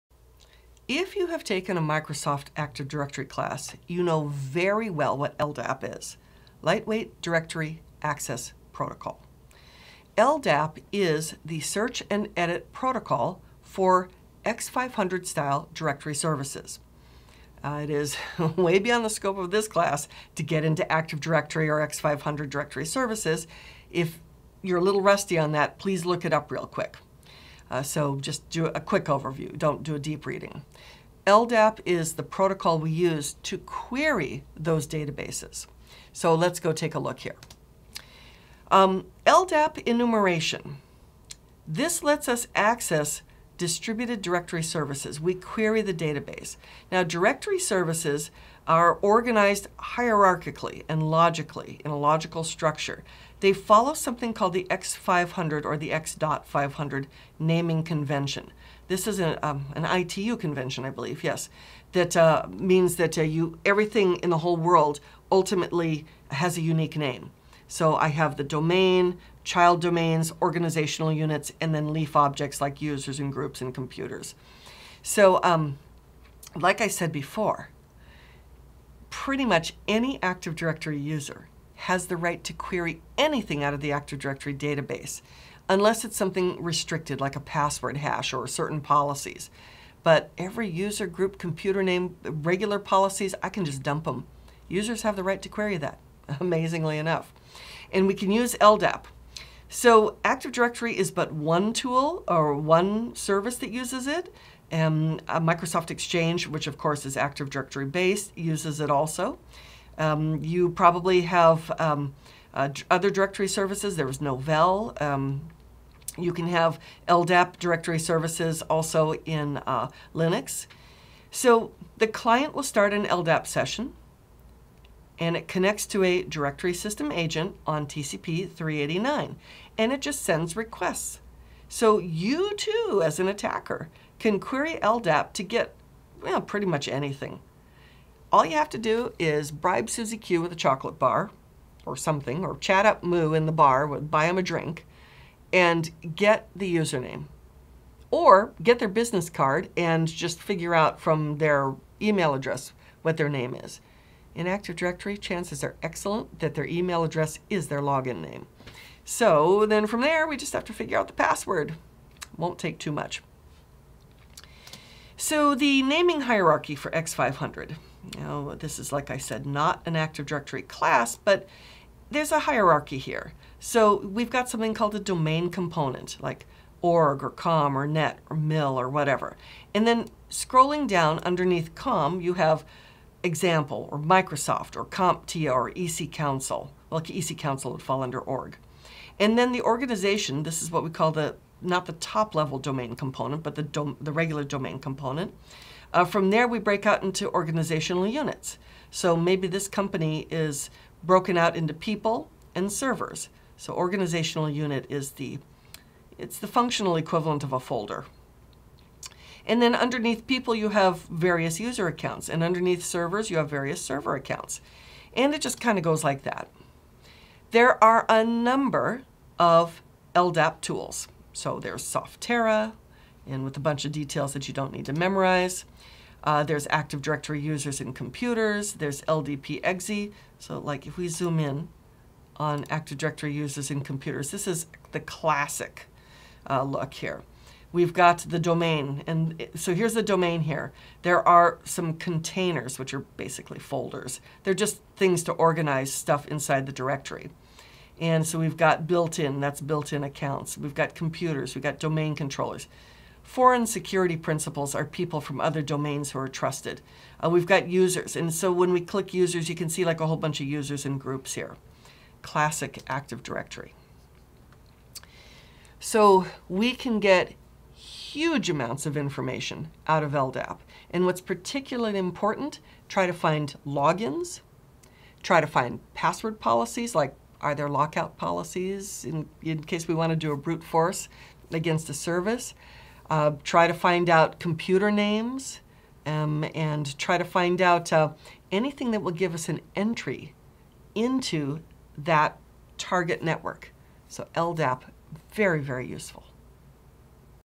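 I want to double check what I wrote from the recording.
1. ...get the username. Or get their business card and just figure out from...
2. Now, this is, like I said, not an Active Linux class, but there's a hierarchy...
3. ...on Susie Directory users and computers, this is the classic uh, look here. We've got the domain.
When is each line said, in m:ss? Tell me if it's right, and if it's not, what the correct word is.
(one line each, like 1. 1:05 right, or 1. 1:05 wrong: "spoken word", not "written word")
1. 2:26 right
2. 2:48 wrong: "Directory", not "Linux"
3. 3:52 wrong: "Active", not "Susie".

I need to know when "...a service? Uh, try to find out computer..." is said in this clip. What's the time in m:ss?
4:41.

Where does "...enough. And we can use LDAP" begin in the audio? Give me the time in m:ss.
1:36.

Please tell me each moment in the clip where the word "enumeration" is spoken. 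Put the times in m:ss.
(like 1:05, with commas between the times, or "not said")
0:39.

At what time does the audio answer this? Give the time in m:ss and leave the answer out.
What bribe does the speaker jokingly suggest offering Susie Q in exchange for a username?
2:20.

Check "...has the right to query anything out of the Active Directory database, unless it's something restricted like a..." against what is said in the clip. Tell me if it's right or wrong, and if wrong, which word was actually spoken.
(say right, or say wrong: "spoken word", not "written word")
right.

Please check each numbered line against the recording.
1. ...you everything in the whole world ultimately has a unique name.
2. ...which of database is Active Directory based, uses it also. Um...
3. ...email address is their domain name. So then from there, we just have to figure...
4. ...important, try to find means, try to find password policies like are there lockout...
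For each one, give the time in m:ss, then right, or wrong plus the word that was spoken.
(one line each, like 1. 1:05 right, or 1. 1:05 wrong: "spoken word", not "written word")
1. 1:03 right
2. 1:46 wrong: "course", not "database"
3. 2:36 wrong: "login", not "domain"
4. 4:31 wrong: "logins", not "means".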